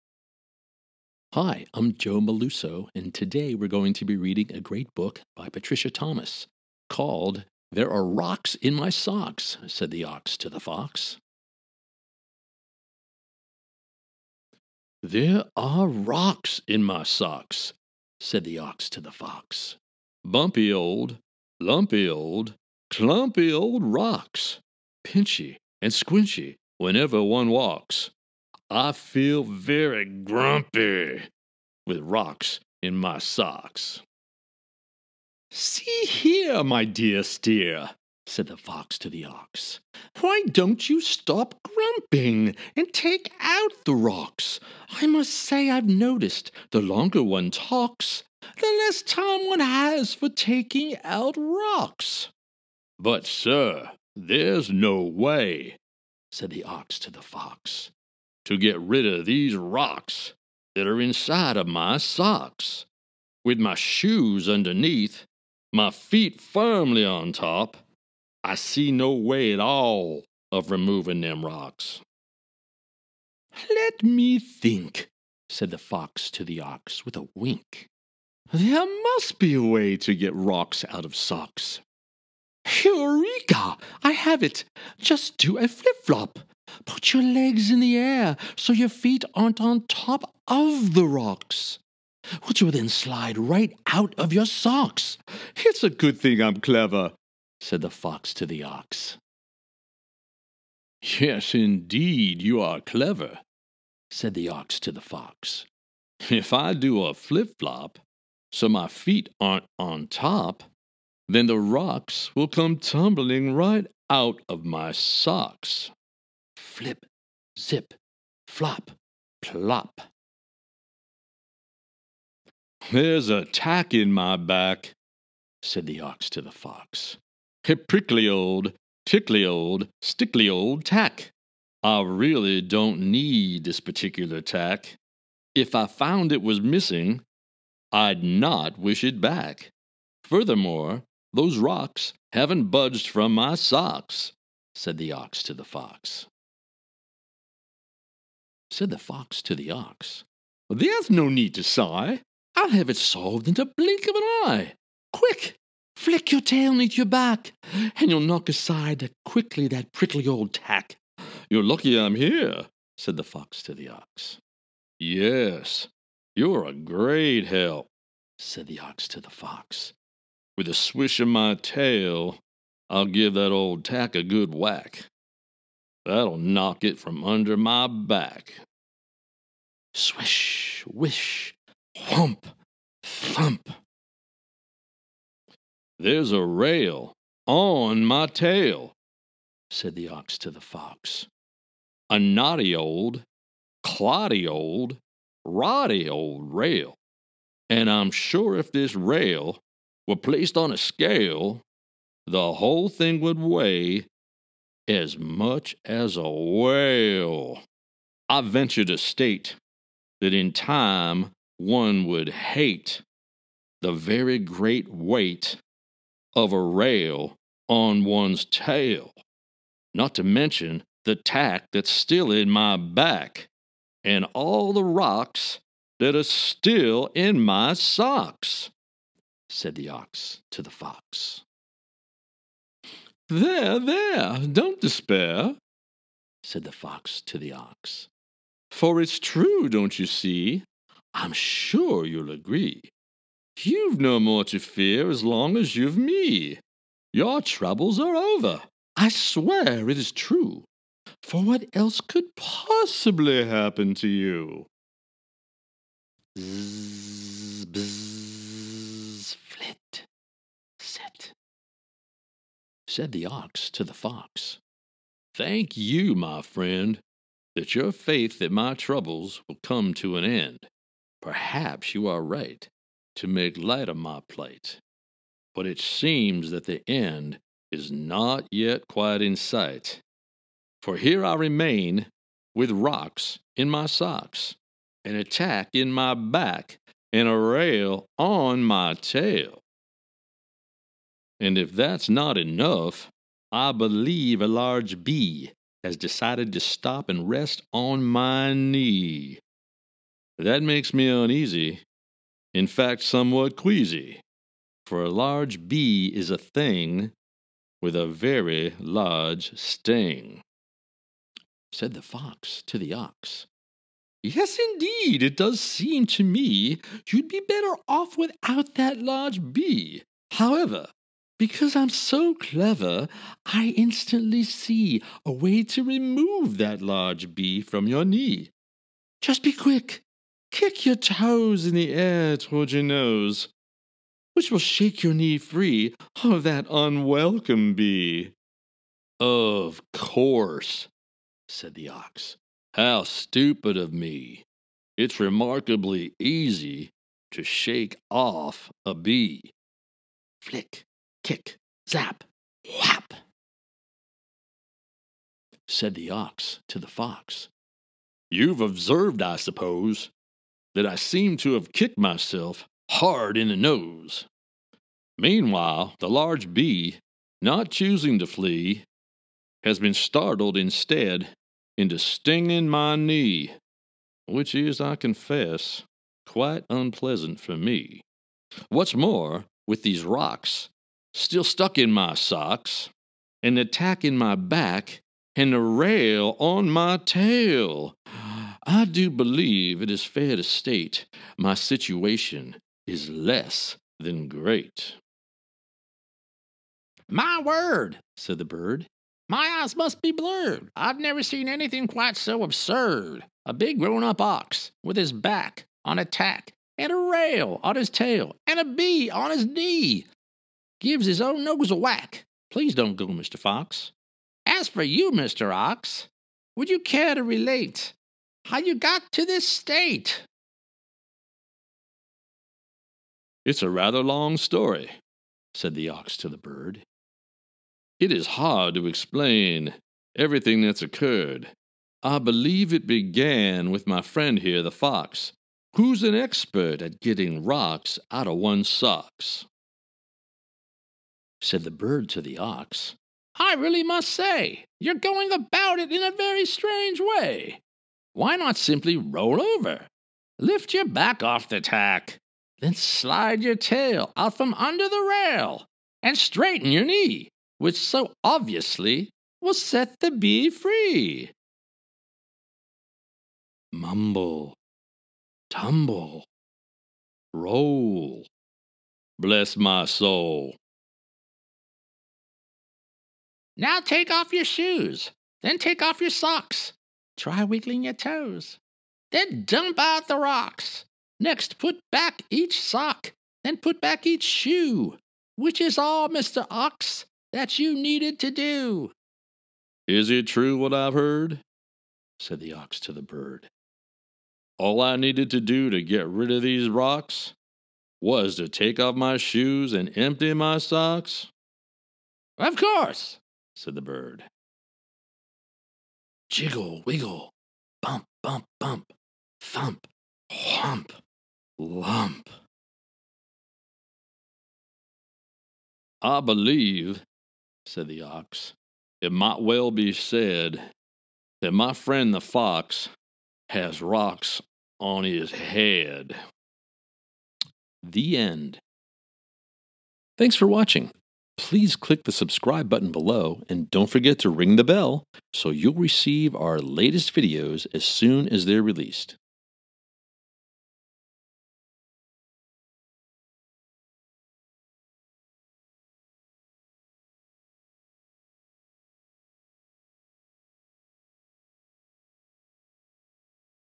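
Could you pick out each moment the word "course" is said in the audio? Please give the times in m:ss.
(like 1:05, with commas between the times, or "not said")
5:39, 8:22.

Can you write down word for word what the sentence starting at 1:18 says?
There must be a way to get rocks out of socks.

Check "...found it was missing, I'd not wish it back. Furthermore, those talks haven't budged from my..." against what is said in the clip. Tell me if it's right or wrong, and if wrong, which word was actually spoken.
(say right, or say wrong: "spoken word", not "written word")
wrong: "rocks", not "talks".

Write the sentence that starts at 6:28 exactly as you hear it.
I do believe it is fair to state my situation is less than great.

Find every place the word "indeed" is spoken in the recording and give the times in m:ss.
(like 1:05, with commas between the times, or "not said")
1:41, 5:14.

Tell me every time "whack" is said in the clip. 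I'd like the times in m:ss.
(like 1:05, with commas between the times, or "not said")
2:54, 6:51.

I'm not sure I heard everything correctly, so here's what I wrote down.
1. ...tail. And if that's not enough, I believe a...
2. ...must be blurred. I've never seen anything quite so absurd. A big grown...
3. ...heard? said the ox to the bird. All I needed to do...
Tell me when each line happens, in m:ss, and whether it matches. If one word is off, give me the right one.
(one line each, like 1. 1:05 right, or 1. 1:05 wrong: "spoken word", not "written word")
1. 4:48 right
2. 6:39 right
3. 8:10 right.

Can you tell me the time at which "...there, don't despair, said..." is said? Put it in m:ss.
3:53.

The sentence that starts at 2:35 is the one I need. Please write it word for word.
Quick, flick your tail neath your back, and you'll knock aside quickly that prickly old tack.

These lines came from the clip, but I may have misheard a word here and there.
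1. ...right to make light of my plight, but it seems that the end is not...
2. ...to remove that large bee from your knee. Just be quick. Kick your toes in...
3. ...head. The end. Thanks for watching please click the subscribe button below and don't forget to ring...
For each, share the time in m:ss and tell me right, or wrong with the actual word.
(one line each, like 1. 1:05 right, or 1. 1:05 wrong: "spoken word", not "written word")
1. 4:32 right
2. 5:25 right
3. 8:45 right.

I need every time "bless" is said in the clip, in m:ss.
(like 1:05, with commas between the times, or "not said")
7:49.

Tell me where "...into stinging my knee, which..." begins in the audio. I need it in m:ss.
6:11.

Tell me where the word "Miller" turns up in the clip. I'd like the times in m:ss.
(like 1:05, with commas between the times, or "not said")
not said.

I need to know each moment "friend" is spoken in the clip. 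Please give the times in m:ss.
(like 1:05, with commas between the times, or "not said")
4:26, 7:14, 8:41.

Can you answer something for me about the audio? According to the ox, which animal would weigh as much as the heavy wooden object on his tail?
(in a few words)
a whale.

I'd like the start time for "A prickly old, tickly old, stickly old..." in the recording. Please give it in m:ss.
2:07.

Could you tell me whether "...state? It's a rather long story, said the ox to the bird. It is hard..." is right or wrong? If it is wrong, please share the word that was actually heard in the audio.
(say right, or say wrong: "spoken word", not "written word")
right.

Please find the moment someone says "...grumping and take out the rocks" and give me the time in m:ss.
0:41.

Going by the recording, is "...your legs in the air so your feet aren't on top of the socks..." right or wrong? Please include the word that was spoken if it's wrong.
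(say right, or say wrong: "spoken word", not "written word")
wrong: "rocks", not "socks".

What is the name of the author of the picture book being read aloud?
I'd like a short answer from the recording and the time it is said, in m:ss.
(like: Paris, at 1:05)
Patricia Thomas, at 0:05.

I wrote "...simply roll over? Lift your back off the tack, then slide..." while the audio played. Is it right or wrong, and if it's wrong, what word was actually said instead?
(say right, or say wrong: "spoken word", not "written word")
right.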